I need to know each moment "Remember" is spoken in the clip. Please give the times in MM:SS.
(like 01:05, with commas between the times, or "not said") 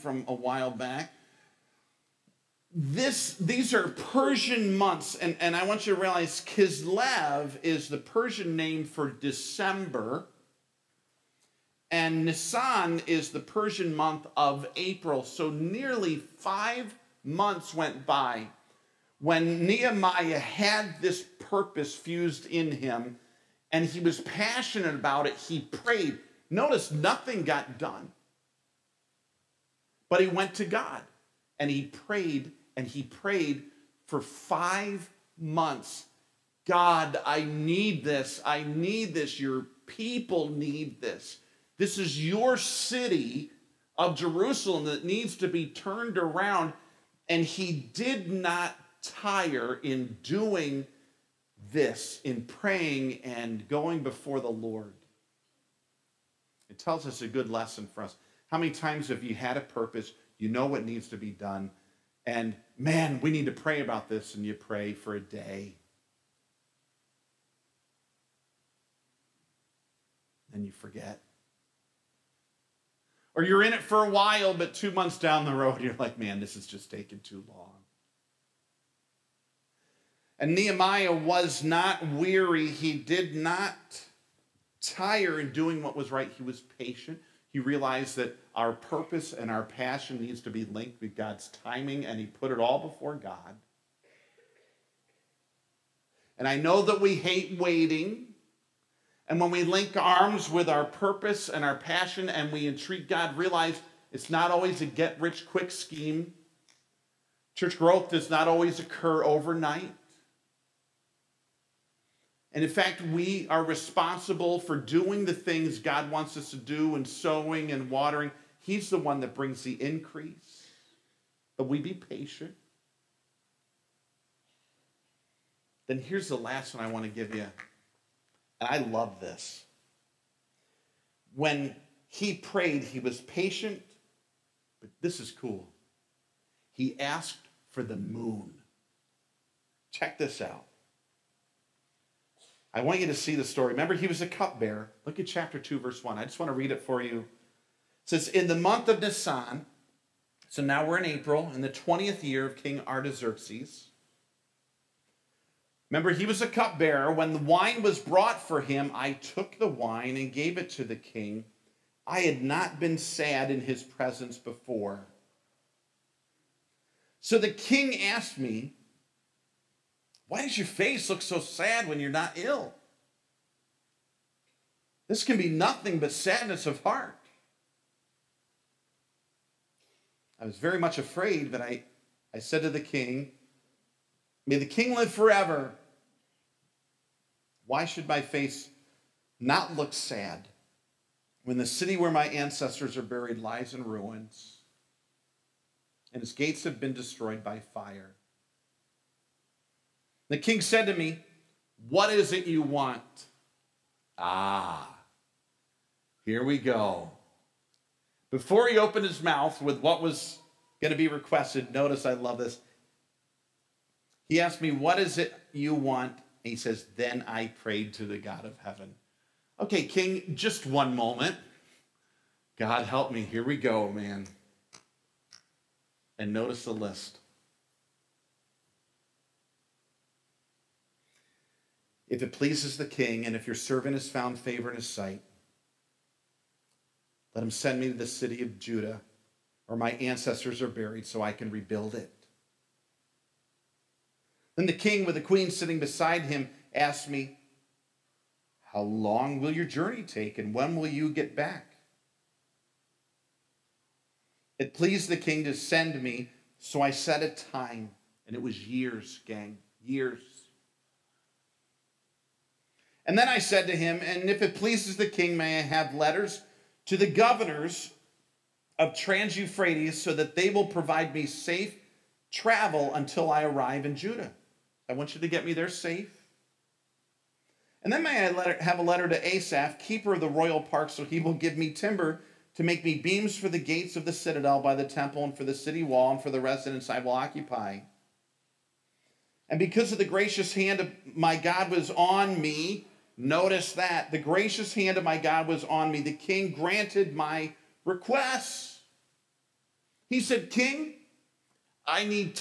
02:23, 02:35.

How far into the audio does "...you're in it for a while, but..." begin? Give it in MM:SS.
01:13.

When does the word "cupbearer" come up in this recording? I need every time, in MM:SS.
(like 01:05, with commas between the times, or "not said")
02:24, 02:36.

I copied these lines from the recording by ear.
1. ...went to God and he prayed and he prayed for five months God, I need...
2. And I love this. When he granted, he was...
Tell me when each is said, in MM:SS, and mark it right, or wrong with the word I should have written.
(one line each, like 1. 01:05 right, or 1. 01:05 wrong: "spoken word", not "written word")
1. 00:30 right
2. 02:08 wrong: "prayed", not "granted".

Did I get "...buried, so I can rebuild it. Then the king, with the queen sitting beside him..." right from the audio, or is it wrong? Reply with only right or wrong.
right.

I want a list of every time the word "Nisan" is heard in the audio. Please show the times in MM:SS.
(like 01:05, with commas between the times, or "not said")
00:12, 02:29.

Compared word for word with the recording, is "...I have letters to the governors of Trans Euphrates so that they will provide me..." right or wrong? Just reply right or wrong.
right.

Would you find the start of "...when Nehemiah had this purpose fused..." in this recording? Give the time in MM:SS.
00:19.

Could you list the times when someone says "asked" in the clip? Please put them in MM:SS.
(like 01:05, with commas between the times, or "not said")
02:16, 02:48, 03:34, 04:06.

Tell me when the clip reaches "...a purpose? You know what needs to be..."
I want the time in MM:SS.
00:59.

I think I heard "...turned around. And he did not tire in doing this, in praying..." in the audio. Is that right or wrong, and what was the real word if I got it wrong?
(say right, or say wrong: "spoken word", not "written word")
right.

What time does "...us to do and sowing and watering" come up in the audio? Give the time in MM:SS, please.
01:56.